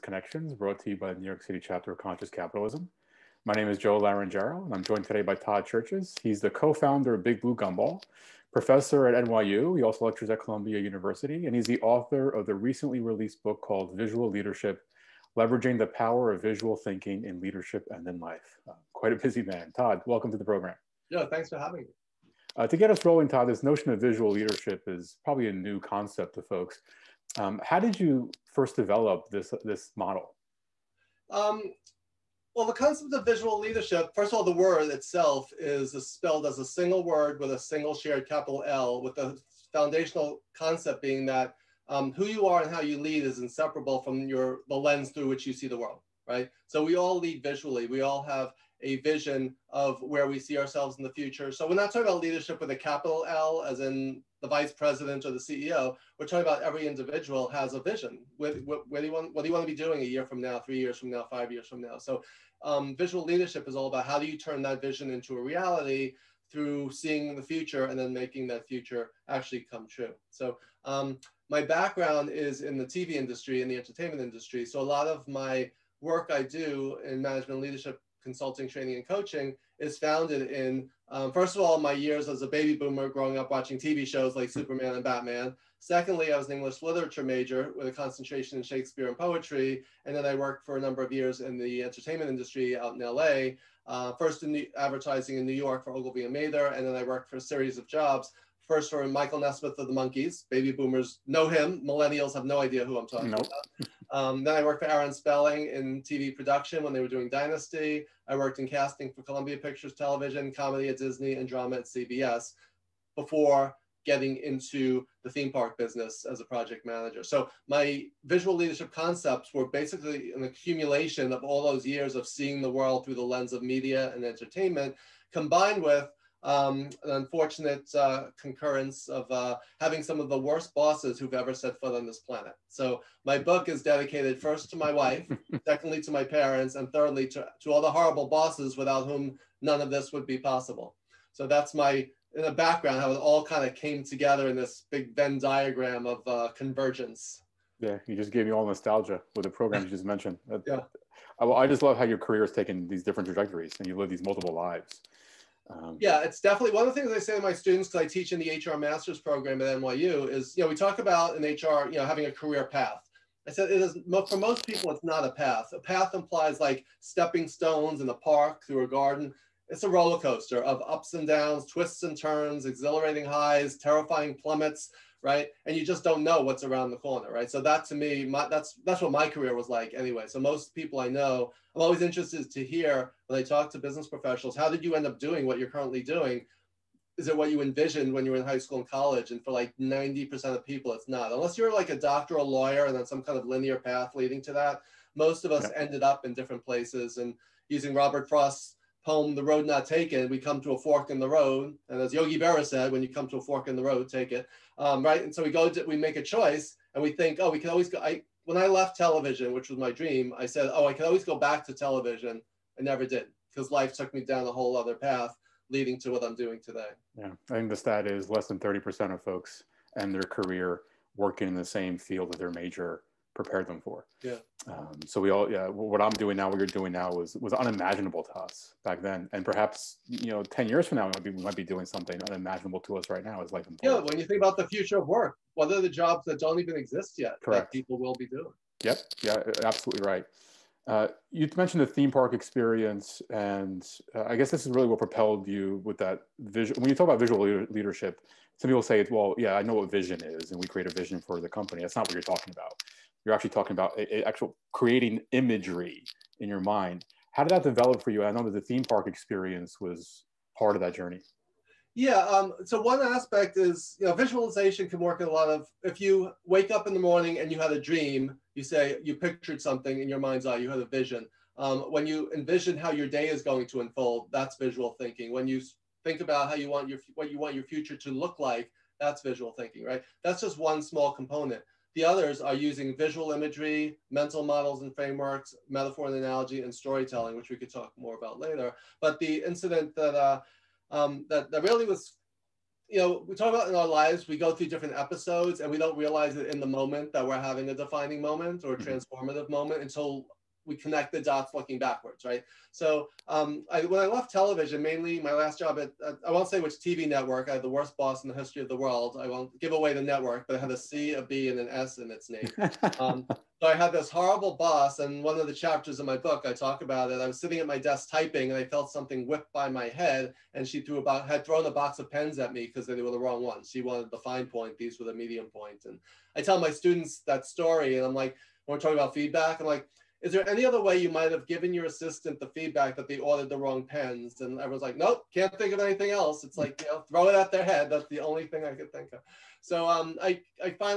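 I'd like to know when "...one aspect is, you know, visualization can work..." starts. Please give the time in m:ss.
4:22.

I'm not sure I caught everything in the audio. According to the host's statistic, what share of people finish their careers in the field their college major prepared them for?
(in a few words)
less than 30%.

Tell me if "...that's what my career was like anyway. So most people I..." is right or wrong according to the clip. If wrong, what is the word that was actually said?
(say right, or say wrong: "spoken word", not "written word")
right.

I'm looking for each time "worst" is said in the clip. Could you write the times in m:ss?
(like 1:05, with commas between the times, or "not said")
2:10, 5:07.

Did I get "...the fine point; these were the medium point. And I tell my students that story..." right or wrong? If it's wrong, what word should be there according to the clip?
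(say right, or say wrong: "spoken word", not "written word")
right.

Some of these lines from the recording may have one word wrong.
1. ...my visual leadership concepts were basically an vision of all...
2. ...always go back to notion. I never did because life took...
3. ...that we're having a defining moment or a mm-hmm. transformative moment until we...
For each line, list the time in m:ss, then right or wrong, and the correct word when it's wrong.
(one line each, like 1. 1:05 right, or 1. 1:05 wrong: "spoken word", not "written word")
1. 1:57 wrong: "accumulation", not "vision"
2. 3:31 wrong: "television", not "notion"
3. 4:57 right.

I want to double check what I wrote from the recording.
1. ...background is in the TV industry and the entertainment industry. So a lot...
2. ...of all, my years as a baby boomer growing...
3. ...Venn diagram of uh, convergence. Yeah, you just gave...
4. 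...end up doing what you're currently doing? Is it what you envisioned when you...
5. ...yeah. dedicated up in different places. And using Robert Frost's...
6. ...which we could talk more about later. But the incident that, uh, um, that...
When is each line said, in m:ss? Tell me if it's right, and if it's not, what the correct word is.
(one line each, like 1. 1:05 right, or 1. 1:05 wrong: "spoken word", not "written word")
1. 1:11 right
2. 1:21 right
3. 2:25 right
4. 3:04 right
5. 3:15 wrong: "ended", not "dedicated"
6. 4:47 right.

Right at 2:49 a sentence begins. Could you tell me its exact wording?
It's a roller coaster of ups and downs, twists and turns, exhilarating highs, terrifying plummets right?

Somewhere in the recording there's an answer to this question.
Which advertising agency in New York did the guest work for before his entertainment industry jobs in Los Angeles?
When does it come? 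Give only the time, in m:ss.
1:35.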